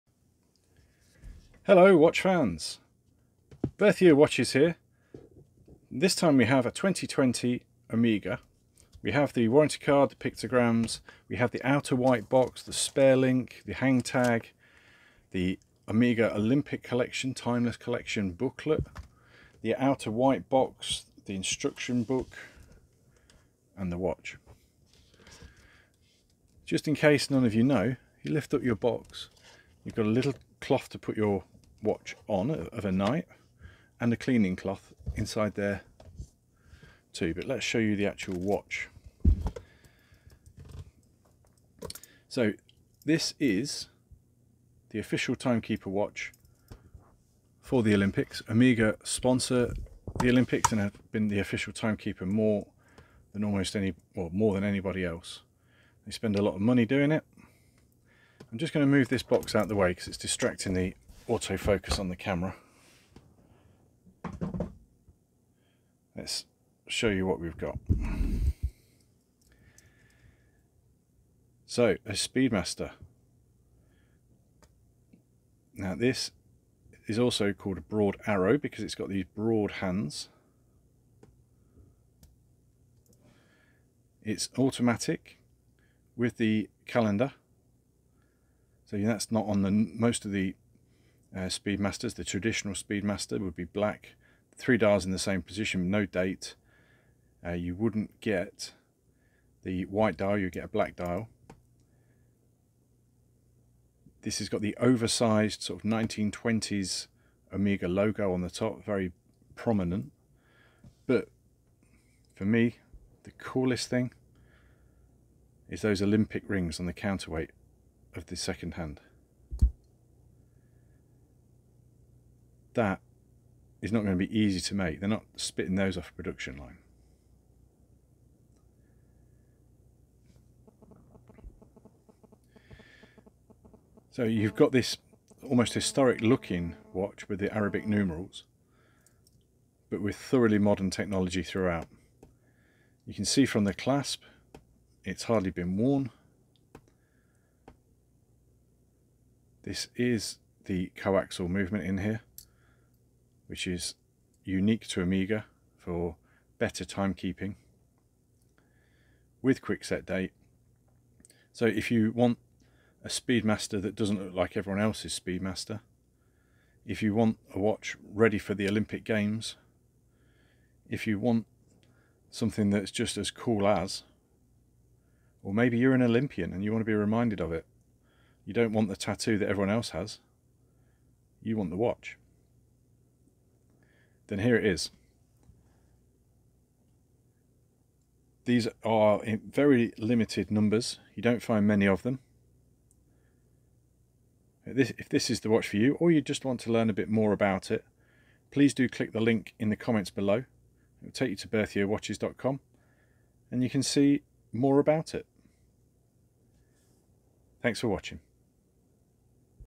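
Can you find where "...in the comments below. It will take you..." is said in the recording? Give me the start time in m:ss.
3:19.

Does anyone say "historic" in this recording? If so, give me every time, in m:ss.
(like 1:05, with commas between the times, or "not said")
2:15.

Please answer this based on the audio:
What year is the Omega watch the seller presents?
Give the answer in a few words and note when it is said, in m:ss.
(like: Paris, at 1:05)
2020, at 0:06.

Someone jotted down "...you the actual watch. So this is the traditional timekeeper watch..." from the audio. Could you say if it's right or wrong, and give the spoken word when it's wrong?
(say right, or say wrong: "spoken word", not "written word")
wrong: "official", not "traditional".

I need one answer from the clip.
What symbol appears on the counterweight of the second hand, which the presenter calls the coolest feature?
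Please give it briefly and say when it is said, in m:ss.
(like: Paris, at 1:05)
Olympic rings, at 1:56.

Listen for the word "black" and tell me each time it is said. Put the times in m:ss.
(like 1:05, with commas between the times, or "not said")
1:33, 1:40.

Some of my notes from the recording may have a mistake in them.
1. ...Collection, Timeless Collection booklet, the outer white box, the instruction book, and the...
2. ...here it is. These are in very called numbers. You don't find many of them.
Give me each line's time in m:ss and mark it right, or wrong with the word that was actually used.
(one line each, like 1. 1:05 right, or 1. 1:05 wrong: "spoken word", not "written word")
1. 0:16 right
2. 3:04 wrong: "limited", not "called".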